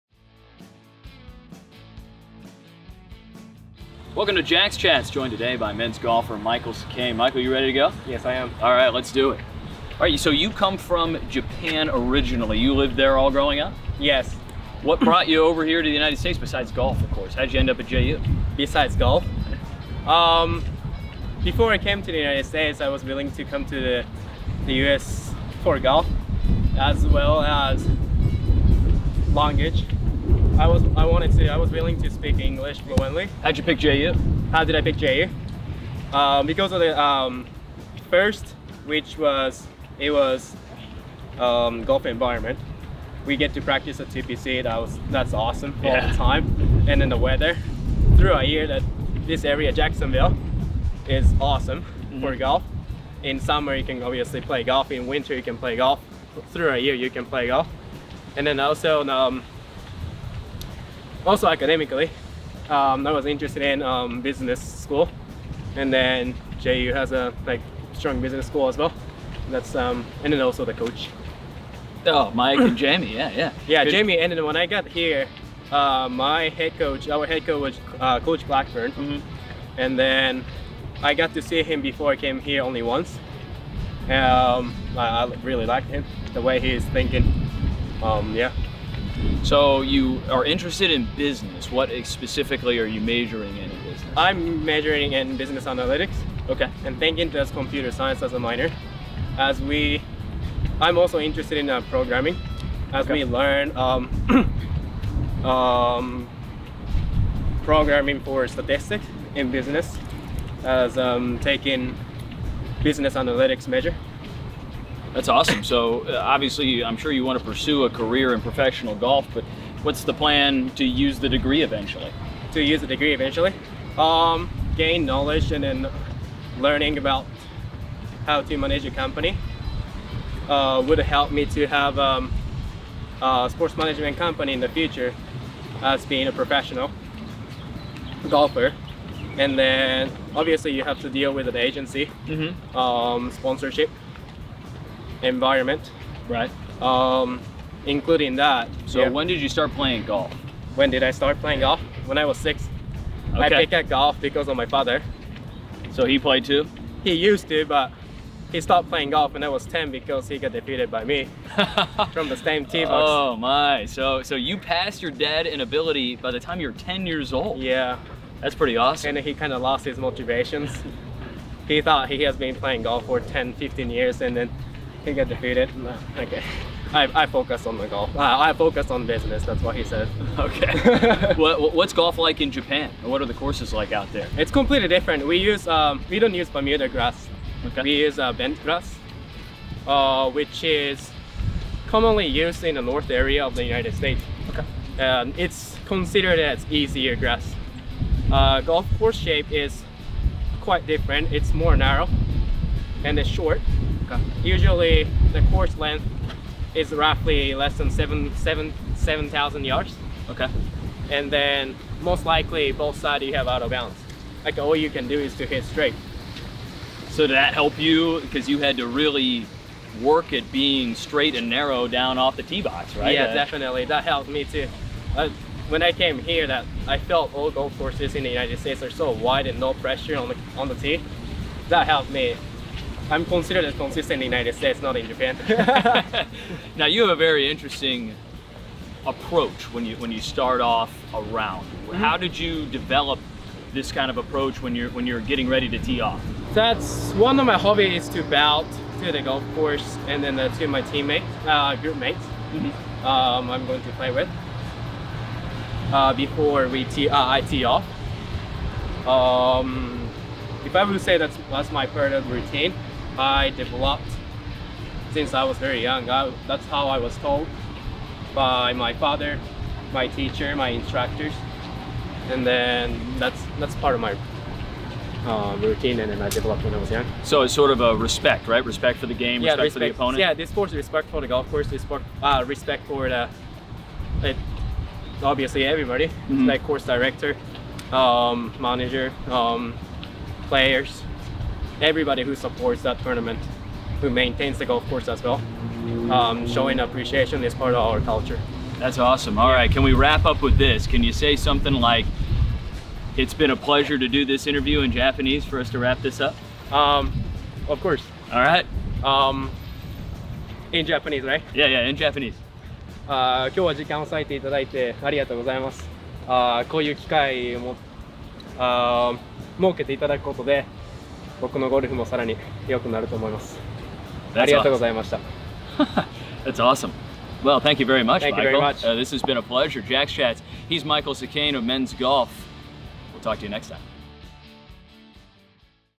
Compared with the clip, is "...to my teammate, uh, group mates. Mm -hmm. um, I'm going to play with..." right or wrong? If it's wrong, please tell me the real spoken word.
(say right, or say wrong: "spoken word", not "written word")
right.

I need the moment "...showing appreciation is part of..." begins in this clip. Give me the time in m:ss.
4:56.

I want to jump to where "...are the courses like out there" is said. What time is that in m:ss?
3:03.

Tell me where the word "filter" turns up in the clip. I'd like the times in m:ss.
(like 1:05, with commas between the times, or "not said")
not said.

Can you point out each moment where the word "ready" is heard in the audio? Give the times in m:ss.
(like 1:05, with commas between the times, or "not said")
0:07, 4:05.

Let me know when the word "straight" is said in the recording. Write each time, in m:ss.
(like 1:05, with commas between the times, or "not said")
3:35, 3:40.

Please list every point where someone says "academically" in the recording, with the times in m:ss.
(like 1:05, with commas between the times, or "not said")
1:01.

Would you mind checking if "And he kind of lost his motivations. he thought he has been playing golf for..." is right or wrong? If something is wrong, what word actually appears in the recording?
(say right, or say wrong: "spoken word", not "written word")
right.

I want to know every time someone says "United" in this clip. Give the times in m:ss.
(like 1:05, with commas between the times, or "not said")
0:15, 0:22, 3:13, 3:48, 3:54.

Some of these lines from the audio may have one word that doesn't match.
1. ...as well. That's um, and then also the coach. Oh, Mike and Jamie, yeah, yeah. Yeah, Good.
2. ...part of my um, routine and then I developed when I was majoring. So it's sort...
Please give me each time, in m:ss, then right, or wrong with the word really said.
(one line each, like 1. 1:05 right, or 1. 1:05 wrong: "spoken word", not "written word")
1. 1:08 right
2. 4:33 wrong: "young", not "majoring".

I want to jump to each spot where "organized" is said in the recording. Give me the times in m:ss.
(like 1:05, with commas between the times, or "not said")
not said.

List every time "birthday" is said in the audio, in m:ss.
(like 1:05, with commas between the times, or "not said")
not said.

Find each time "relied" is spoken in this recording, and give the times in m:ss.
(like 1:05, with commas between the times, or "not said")
not said.